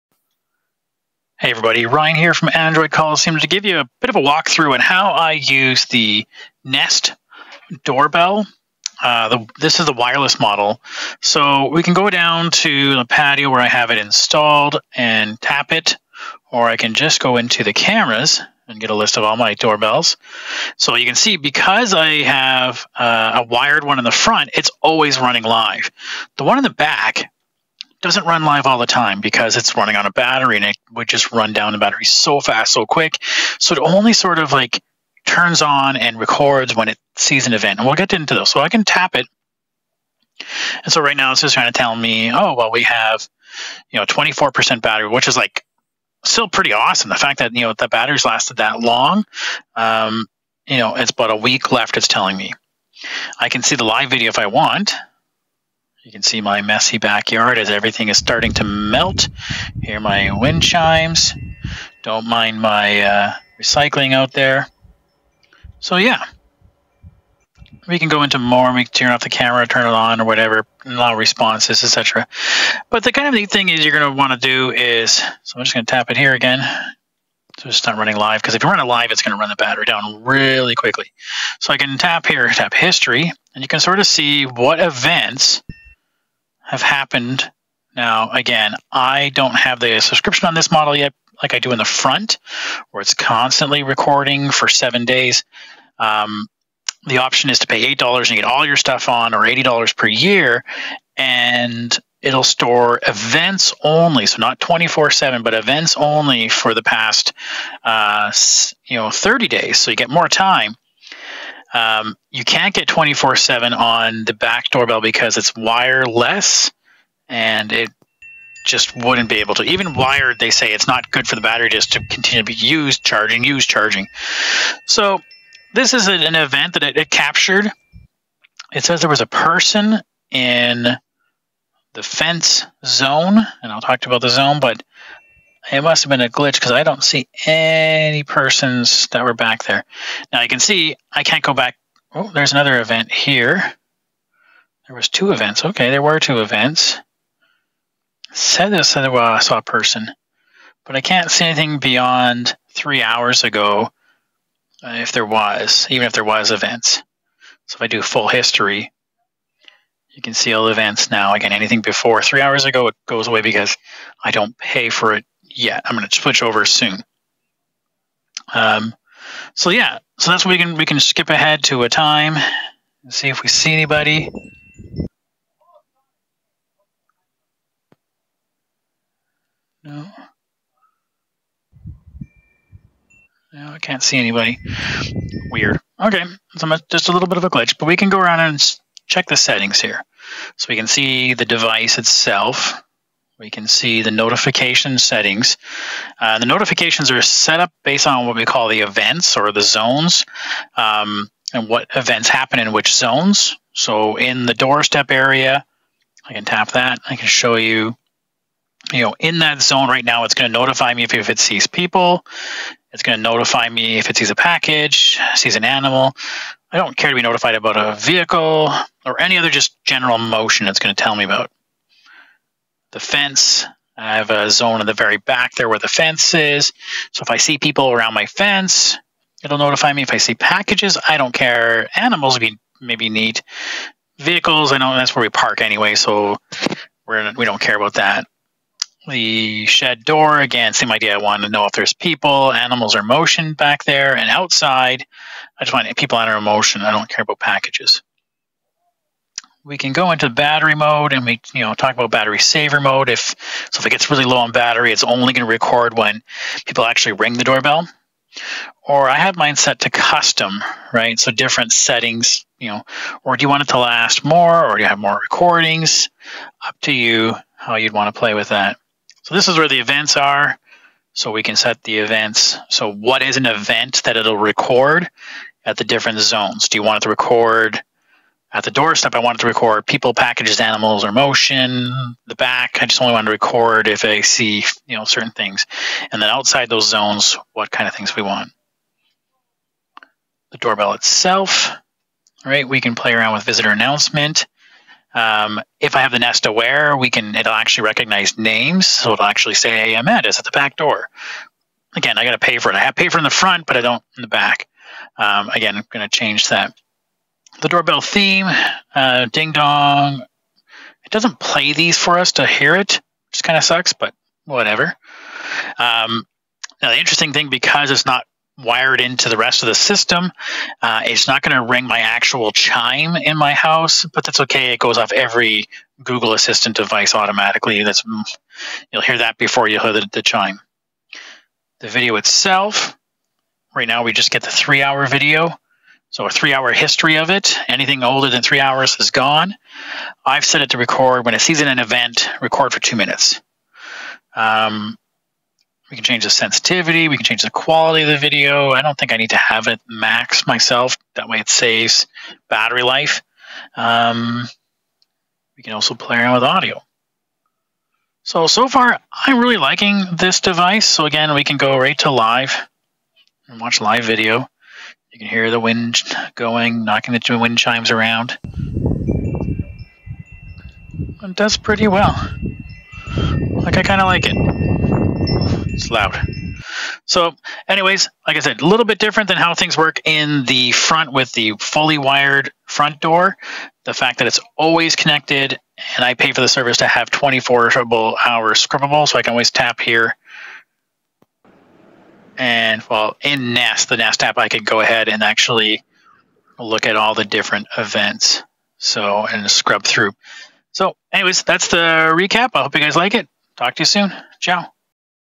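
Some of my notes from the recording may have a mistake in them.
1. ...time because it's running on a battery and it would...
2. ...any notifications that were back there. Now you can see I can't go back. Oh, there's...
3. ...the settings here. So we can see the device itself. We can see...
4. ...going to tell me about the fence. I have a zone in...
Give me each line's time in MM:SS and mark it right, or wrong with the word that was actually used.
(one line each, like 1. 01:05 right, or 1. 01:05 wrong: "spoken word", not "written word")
1. 00:28 right
2. 02:17 wrong: "persons", not "notifications"
3. 03:09 right
4. 03:40 right.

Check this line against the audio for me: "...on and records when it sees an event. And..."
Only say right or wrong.
right.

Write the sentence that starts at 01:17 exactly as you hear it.
So it's not running live because if you run it live, it's going to run the battery down really quickly.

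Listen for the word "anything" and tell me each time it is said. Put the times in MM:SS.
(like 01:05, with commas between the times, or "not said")
02:31, 02:41, 05:37.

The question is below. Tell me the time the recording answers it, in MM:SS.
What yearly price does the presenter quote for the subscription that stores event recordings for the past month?
01:39.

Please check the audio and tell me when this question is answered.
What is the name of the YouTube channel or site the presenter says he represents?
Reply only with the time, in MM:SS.
00:02.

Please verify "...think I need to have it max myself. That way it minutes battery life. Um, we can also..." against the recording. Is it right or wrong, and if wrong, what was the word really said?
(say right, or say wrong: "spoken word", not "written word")
wrong: "saves", not "minutes".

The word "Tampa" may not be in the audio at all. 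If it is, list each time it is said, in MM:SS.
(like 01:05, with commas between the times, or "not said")
not said.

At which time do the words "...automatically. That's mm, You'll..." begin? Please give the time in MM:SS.
05:27.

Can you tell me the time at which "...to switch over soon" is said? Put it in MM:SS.
02:46.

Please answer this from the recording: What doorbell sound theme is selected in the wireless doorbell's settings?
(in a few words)
Ding Dong.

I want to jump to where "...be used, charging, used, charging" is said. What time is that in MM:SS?
02:02.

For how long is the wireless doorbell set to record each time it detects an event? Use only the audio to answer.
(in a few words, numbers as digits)
2 minutes.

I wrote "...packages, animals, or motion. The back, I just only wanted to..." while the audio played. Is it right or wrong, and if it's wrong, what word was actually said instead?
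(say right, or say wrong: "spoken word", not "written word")
right.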